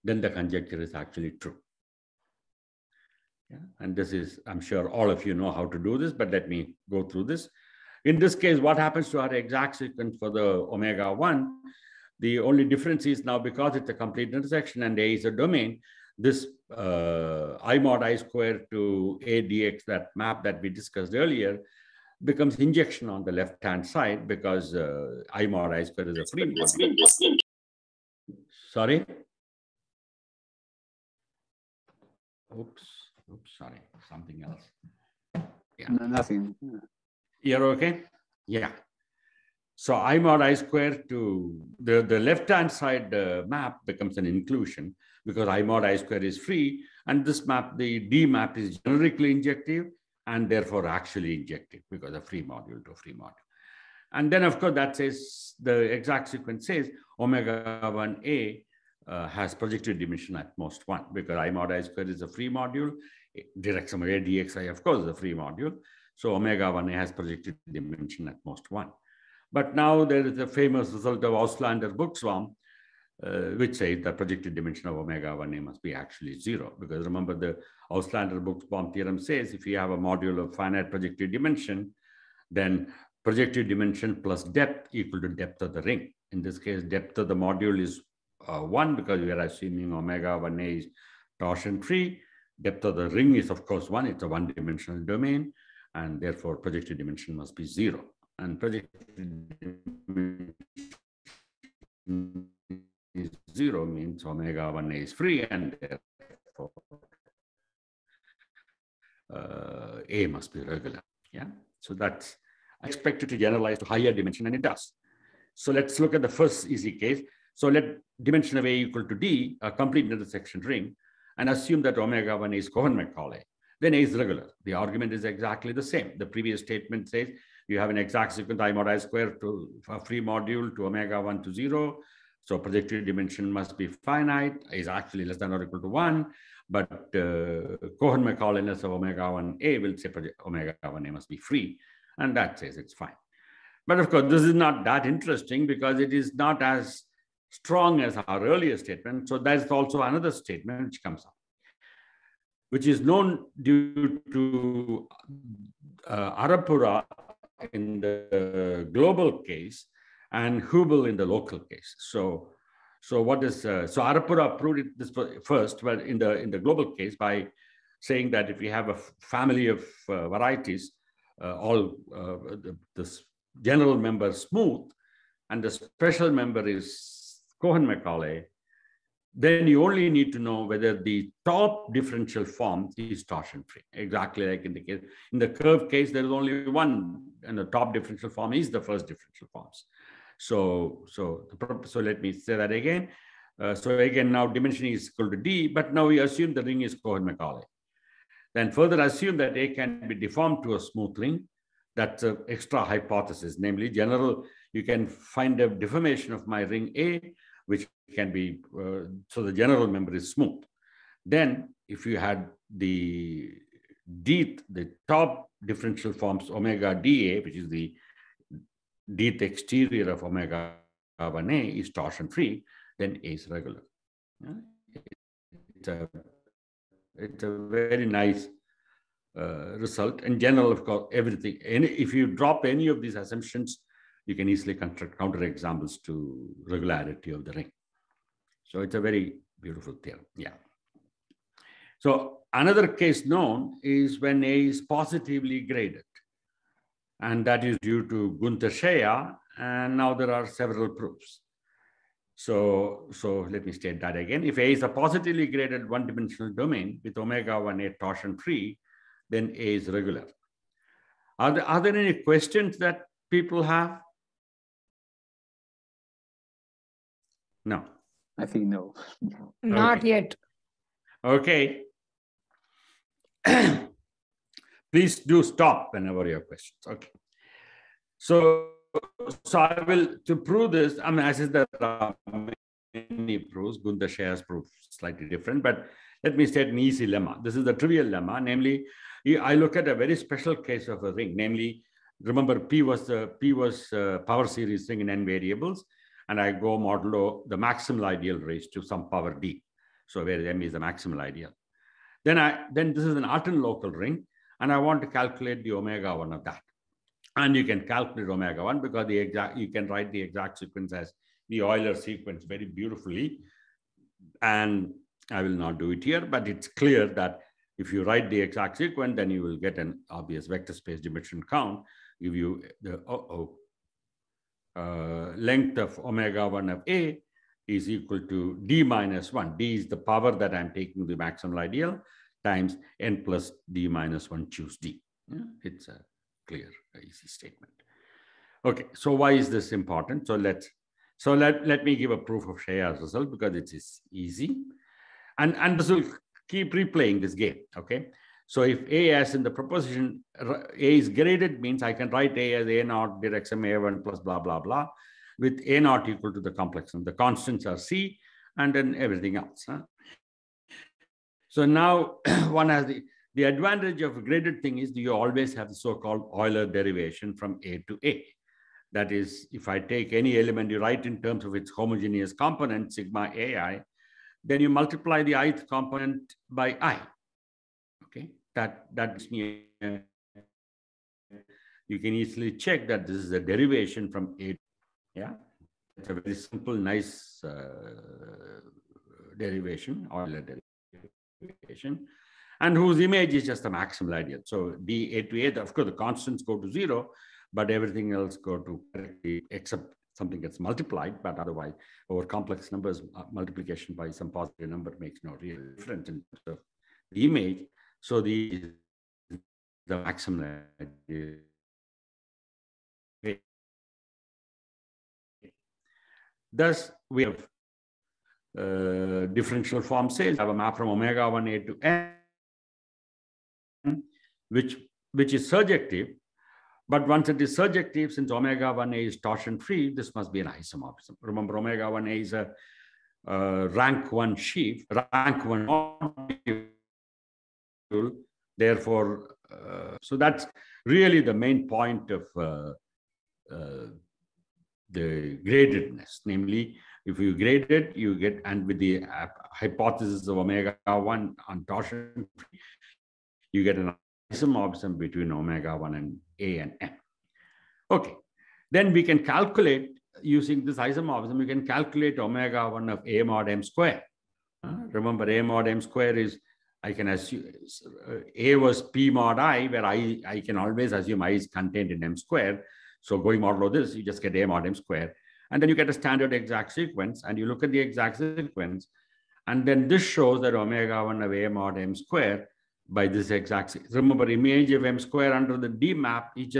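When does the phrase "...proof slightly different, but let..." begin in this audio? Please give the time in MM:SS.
04:44.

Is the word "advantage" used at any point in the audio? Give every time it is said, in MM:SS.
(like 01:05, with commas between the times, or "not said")
06:03.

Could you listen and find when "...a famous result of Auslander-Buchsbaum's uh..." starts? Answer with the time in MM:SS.
01:10.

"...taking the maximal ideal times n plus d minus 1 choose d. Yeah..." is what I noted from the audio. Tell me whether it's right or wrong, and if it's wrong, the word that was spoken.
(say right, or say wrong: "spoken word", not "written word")
right.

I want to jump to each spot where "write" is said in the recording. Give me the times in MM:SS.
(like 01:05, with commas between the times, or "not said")
05:09, 05:18, 05:52, 06:10.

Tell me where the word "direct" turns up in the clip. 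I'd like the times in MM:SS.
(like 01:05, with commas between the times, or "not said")
01:03, 05:53.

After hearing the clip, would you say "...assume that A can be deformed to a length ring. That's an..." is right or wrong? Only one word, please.
wrong.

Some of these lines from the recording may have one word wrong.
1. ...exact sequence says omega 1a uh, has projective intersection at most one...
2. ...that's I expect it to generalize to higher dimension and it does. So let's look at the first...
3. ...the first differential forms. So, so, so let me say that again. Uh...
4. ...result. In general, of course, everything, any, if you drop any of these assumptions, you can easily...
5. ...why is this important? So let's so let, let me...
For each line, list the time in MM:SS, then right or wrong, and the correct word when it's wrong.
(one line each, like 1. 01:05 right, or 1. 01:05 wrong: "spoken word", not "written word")
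1. 00:55 wrong: "dimension", not "intersection"
2. 01:51 right
3. 03:08 right
4. 03:49 right
5. 05:39 right.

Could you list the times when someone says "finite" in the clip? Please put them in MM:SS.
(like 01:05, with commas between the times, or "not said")
01:20, 02:13.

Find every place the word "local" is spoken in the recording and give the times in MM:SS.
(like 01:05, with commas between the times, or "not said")
02:41, 05:03.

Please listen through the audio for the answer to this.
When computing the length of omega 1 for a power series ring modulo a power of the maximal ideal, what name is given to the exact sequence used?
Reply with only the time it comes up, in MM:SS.
05:11.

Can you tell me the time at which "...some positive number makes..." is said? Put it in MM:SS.
06:44.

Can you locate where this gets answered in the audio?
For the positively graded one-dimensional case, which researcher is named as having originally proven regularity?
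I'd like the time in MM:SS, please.
04:08.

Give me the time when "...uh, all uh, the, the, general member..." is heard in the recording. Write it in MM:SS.
02:51.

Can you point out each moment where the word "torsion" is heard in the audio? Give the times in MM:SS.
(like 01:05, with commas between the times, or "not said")
01:31, 03:03, 03:41, 04:17, 07:09, 07:31.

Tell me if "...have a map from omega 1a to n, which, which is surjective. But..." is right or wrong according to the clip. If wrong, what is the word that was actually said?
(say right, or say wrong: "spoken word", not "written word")
right.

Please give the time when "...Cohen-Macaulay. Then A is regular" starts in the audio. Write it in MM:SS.
02:02.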